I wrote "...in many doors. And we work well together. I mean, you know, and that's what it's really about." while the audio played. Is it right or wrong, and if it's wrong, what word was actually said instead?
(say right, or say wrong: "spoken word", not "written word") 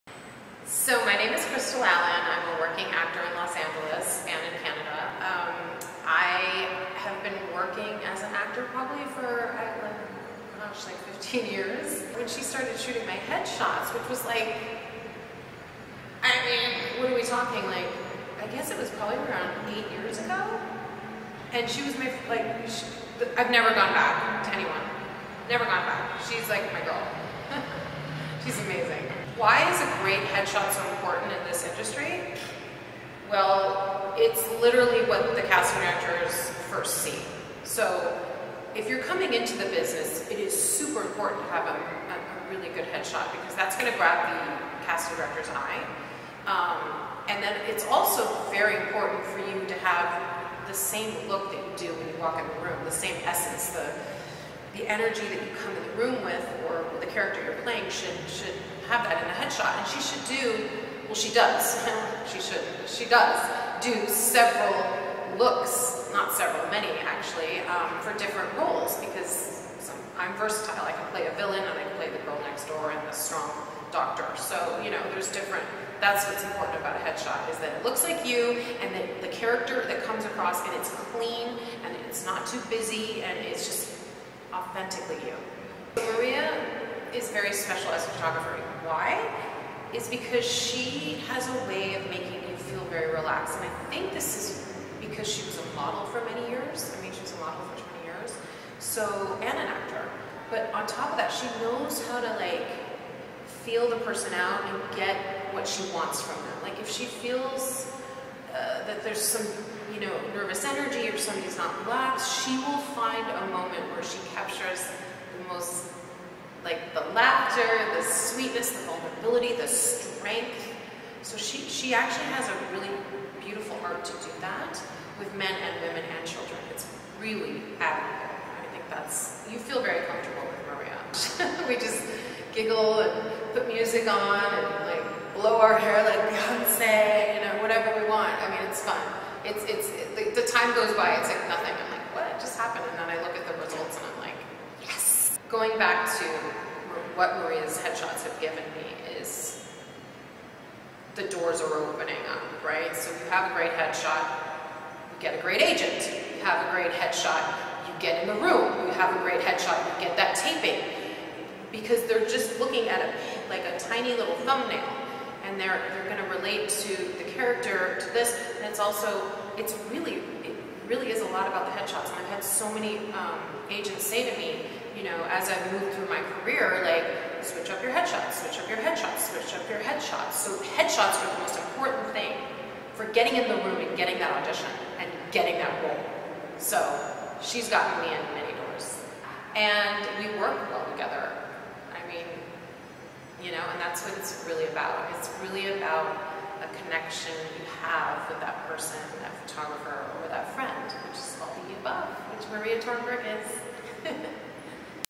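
right.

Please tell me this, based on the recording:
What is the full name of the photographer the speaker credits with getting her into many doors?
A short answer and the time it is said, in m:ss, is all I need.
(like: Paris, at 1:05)
Maria Tornberg, at 3:22.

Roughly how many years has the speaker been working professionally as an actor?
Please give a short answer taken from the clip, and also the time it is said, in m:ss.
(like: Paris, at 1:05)
15, at 0:11.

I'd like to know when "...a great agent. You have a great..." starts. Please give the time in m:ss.
2:35.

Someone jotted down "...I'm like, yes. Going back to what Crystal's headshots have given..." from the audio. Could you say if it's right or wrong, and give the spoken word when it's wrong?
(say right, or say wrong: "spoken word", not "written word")
wrong: "Maria", not "Crystal".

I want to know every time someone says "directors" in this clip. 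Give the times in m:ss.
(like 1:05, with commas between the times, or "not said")
0:35, 0:45.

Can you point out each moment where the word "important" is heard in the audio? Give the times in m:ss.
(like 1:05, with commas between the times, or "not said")
0:30, 0:41, 0:48, 1:16, 3:01.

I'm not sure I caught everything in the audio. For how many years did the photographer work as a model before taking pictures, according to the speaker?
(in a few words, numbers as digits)
20.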